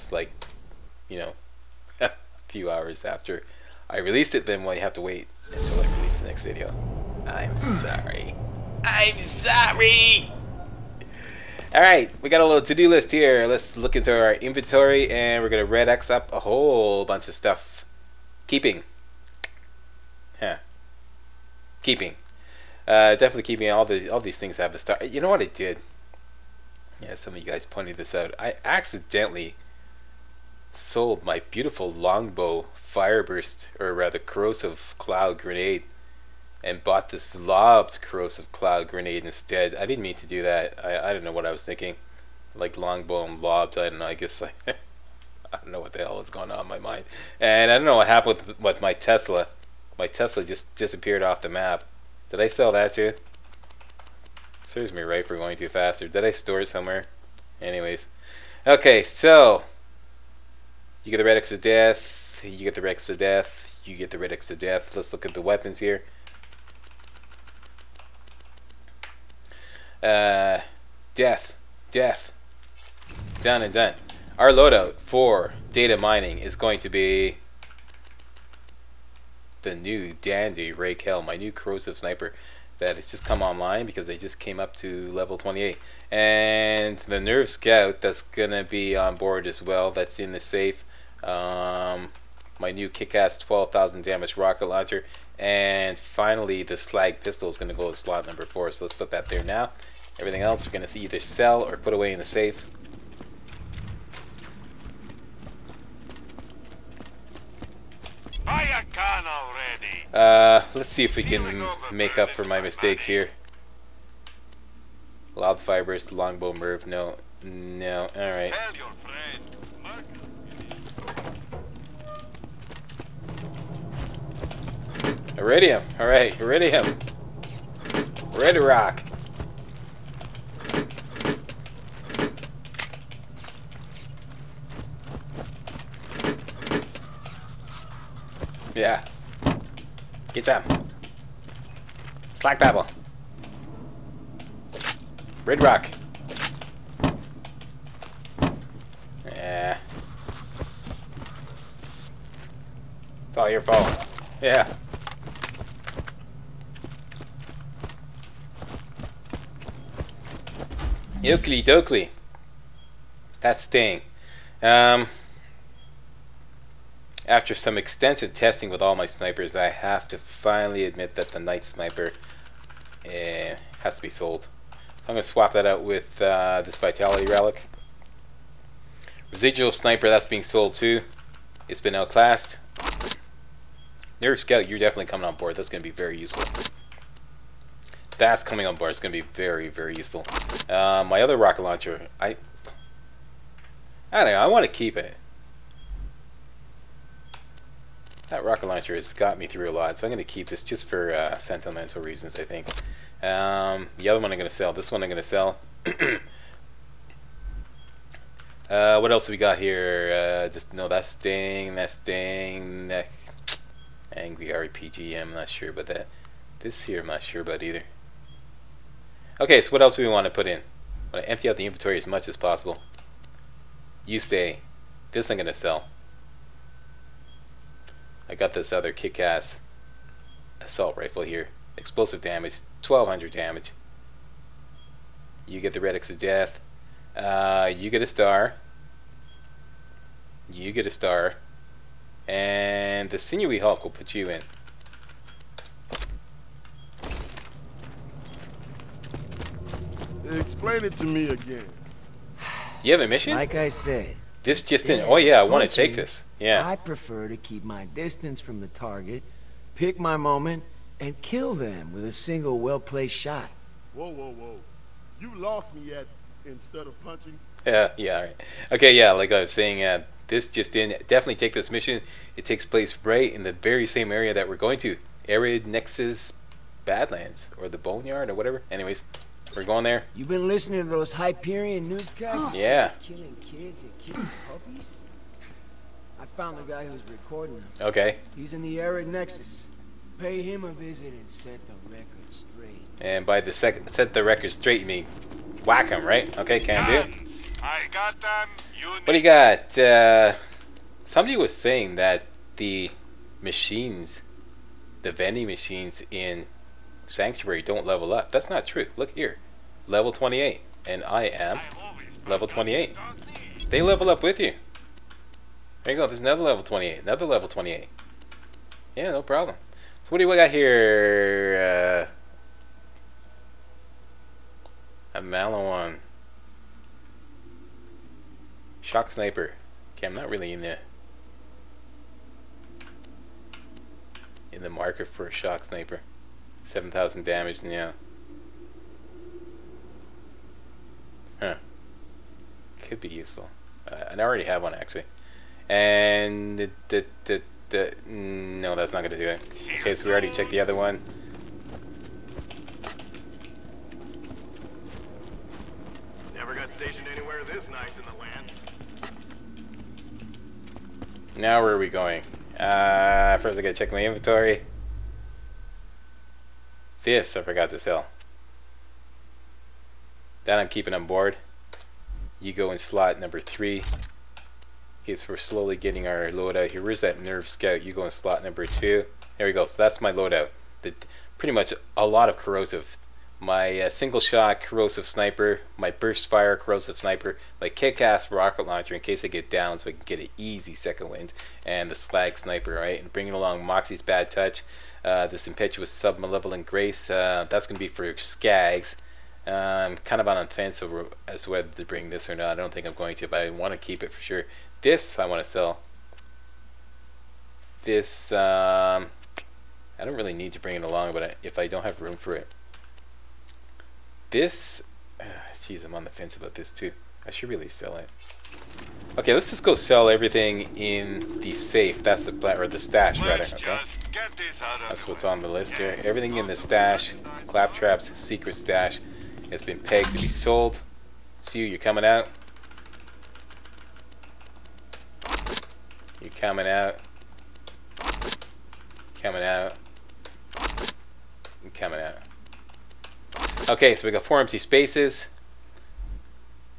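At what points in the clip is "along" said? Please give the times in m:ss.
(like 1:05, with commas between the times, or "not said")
6:33, 6:50.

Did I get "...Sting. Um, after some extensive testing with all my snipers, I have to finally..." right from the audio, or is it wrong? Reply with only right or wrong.
right.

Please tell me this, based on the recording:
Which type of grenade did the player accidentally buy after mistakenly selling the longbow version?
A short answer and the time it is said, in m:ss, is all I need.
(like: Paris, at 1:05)
Lobbed corrosive cloud grenade, at 0:37.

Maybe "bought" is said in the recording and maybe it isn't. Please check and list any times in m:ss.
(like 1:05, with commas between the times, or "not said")
0:36.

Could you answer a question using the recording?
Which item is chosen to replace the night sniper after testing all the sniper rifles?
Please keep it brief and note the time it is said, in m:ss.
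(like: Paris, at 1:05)
Vitality relic, at 2:56.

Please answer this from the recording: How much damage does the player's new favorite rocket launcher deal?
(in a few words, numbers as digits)
12,000.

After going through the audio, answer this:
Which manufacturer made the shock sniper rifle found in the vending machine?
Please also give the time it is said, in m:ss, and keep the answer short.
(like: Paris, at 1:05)
Maliwan, at 5:25.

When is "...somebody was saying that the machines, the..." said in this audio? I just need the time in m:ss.
5:01.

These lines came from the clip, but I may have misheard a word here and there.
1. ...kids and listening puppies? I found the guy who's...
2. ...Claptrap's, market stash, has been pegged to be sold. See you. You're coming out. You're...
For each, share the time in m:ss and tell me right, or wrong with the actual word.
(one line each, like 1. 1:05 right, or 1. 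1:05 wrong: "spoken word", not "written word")
1. 4:43 wrong: "killing", not "listening"
2. 7:07 wrong: "secret", not "market".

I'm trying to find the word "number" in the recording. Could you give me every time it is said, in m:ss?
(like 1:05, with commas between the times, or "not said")
1:38, 6:13, 6:18.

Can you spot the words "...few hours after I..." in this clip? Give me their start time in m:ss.
0:02.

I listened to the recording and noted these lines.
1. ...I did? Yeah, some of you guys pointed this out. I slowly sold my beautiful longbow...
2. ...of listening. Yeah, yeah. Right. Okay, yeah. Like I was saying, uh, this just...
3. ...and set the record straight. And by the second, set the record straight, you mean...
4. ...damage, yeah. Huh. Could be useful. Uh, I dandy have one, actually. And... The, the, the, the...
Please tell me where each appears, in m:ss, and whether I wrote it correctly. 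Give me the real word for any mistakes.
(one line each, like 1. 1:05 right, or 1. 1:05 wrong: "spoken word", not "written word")
1. 0:25 wrong: "accidentally", not "slowly"
2. 4:26 wrong: "punching", not "listening"
3. 4:51 right
4. 5:37 wrong: "already", not "dandy".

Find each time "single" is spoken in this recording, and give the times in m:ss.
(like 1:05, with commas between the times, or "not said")
4:22, 6:23.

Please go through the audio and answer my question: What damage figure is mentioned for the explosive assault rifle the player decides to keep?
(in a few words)
1200.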